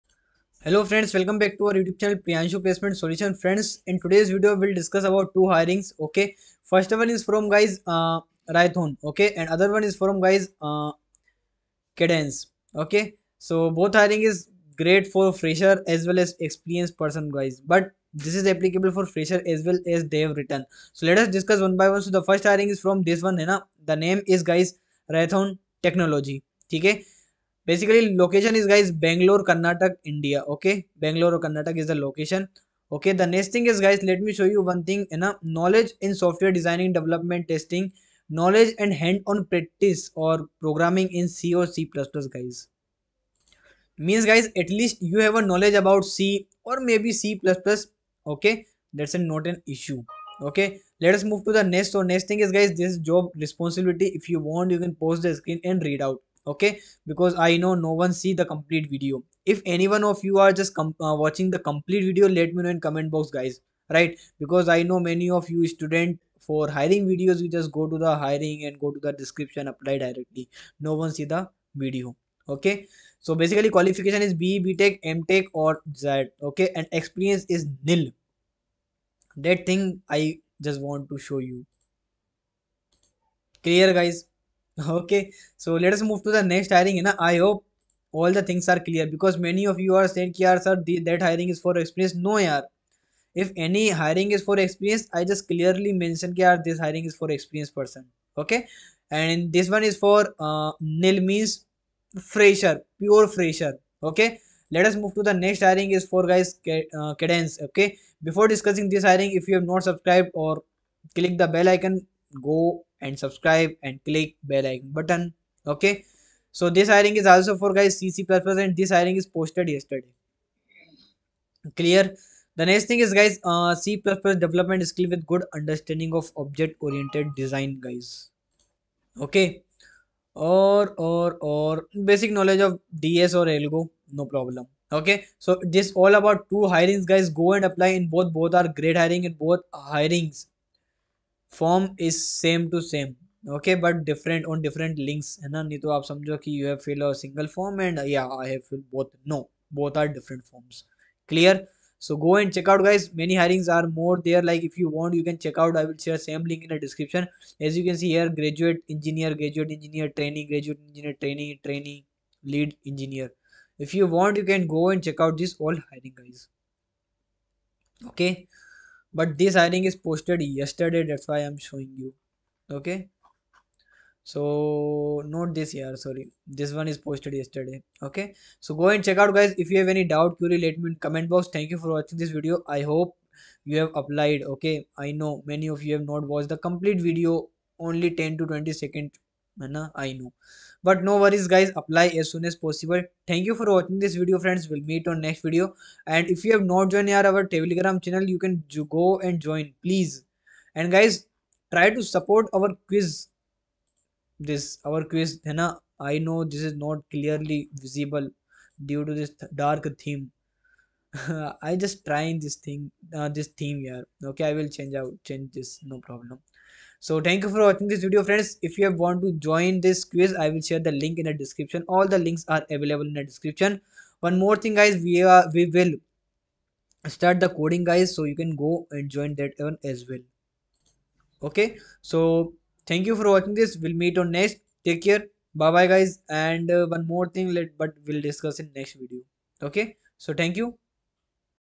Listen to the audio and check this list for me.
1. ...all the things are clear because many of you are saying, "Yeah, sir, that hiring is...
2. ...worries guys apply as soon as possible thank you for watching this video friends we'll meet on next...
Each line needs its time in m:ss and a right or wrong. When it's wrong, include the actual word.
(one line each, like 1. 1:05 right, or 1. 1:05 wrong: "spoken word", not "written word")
1. 1:28 right
2. 3:11 right.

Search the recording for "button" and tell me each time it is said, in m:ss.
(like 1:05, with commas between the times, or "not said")
1:54.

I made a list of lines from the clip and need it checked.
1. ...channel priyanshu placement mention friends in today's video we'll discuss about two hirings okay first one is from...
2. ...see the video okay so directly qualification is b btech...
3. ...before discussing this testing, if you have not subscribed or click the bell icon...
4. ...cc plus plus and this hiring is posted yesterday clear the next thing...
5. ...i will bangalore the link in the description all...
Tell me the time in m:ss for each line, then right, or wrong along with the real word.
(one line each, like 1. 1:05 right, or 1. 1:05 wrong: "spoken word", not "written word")
1. 0:02 wrong: "solution", not "mention"
2. 1:11 wrong: "basically", not "directly"
3. 1:48 wrong: "hiring", not "testing"
4. 1:57 right
5. 3:40 wrong: "share", not "bangalore".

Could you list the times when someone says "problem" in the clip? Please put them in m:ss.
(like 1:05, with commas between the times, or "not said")
2:14, 3:36.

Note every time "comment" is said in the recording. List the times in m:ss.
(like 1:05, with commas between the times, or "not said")
1:02, 3:01.